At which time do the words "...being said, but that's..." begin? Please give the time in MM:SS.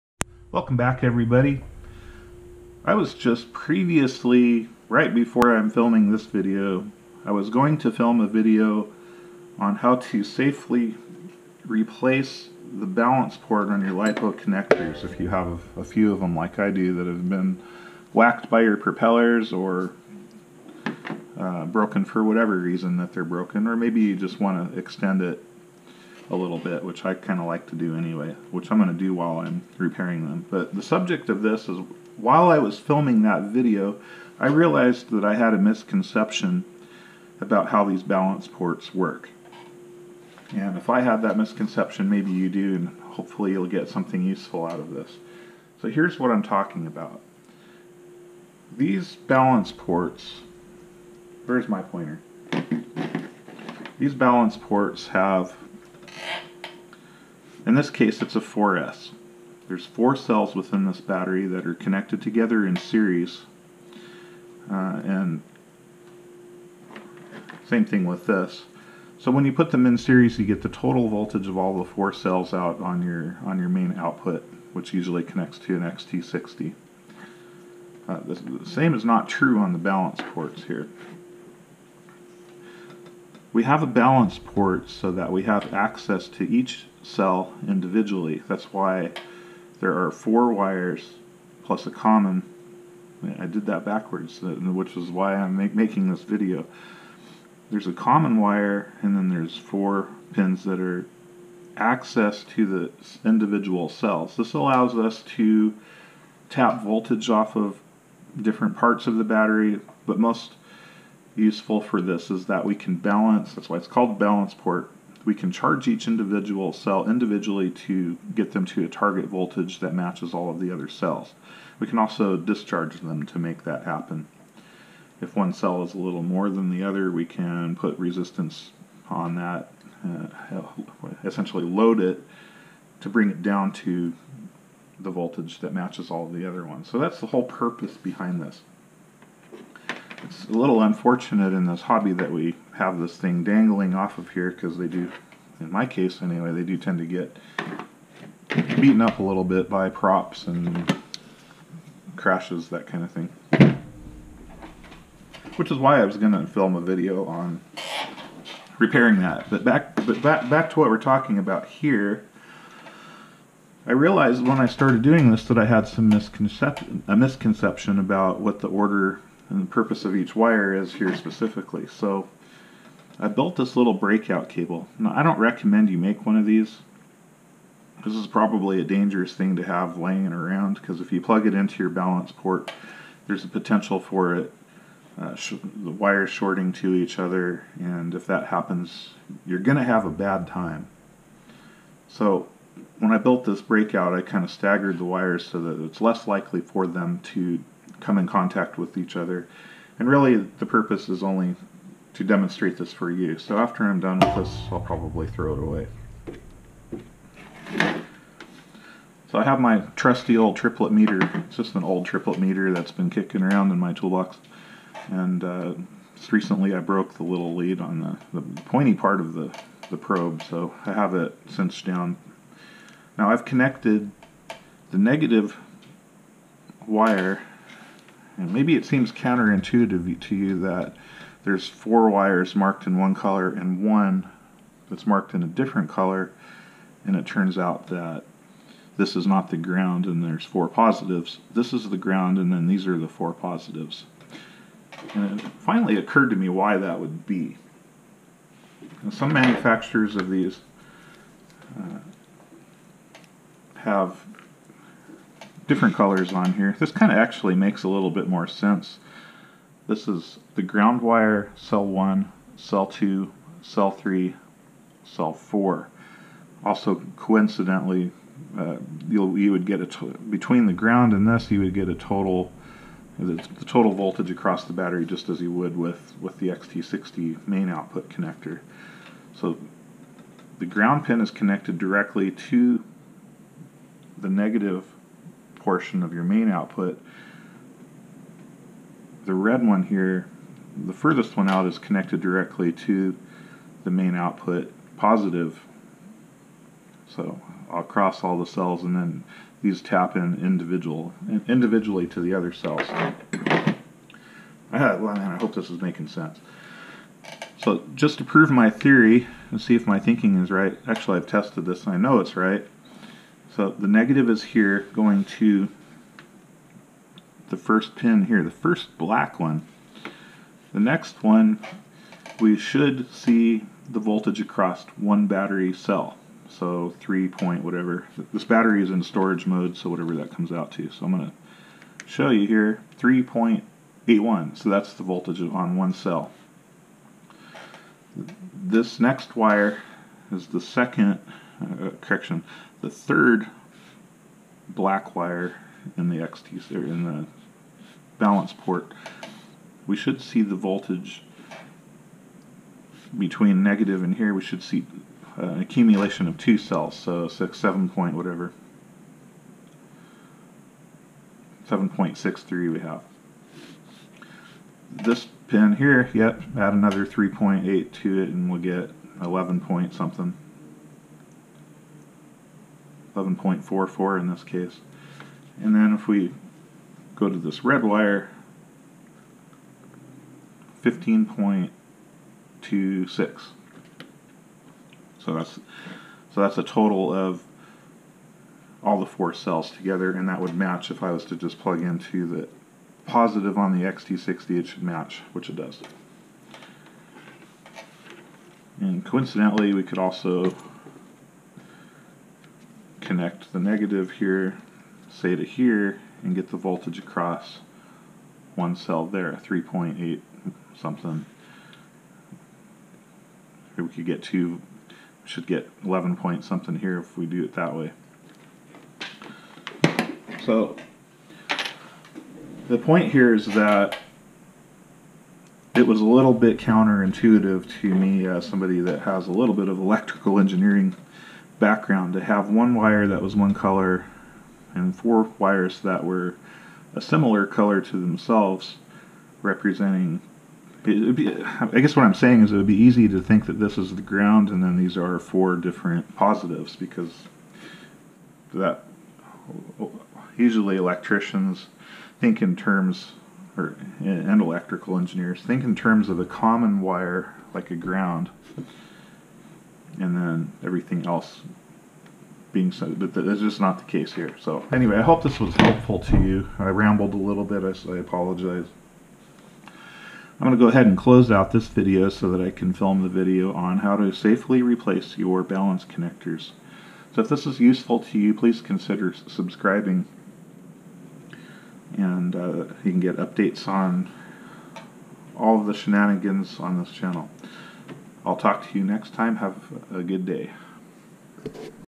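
07:42.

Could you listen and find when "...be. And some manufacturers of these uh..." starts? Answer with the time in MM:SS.
04:07.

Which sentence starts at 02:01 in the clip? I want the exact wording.
We can also discharge them to make that happen.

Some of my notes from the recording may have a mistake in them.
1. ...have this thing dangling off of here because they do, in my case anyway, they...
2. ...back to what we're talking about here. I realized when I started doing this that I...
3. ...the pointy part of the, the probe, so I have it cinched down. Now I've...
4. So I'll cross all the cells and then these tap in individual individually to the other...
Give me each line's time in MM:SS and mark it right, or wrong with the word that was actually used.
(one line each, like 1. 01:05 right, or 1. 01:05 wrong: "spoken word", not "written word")
1. 02:22 right
2. 02:40 right
3. 03:38 right
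4. 04:57 right.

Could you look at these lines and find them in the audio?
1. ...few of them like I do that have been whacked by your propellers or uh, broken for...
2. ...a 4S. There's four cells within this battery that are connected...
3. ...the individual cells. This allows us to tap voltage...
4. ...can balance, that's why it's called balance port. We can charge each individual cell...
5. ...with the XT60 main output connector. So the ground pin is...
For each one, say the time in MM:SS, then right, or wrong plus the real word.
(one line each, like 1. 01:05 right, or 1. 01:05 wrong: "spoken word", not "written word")
1. 00:15 right
2. 00:58 right
3. 01:42 right
4. 01:52 right
5. 04:36 right.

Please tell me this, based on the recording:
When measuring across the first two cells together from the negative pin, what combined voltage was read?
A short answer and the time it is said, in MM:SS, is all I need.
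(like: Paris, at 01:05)
7.63, at 06:01.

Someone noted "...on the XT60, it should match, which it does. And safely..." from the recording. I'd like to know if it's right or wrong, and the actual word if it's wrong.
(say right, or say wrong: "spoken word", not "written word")
wrong: "coincidentally", not "safely".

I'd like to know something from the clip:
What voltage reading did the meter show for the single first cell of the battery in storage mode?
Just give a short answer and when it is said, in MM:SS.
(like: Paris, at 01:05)
3.81, at 05:32.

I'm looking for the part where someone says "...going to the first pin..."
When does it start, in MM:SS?
05:14.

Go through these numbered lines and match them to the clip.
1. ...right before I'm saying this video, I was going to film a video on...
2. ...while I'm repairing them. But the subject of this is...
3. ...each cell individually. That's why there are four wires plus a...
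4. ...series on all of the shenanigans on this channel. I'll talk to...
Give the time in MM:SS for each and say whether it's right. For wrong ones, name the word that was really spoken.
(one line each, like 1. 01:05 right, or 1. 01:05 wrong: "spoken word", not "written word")
1. 00:04 wrong: "filming", not "saying"
2. 00:29 right
3. 01:26 right
4. 08:03 wrong: "updates", not "series".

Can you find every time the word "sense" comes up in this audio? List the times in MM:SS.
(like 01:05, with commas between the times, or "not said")
04:18, 05:06.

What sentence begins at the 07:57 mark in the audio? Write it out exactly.
So if this is useful to you, please consider subscribing.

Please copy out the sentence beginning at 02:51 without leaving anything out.
So I built this little breakout cable.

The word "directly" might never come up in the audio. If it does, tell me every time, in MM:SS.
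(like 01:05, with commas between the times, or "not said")
04:41, 04:52.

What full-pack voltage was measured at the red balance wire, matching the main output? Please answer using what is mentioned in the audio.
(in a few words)
15.26.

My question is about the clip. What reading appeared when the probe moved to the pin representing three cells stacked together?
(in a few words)
11.44.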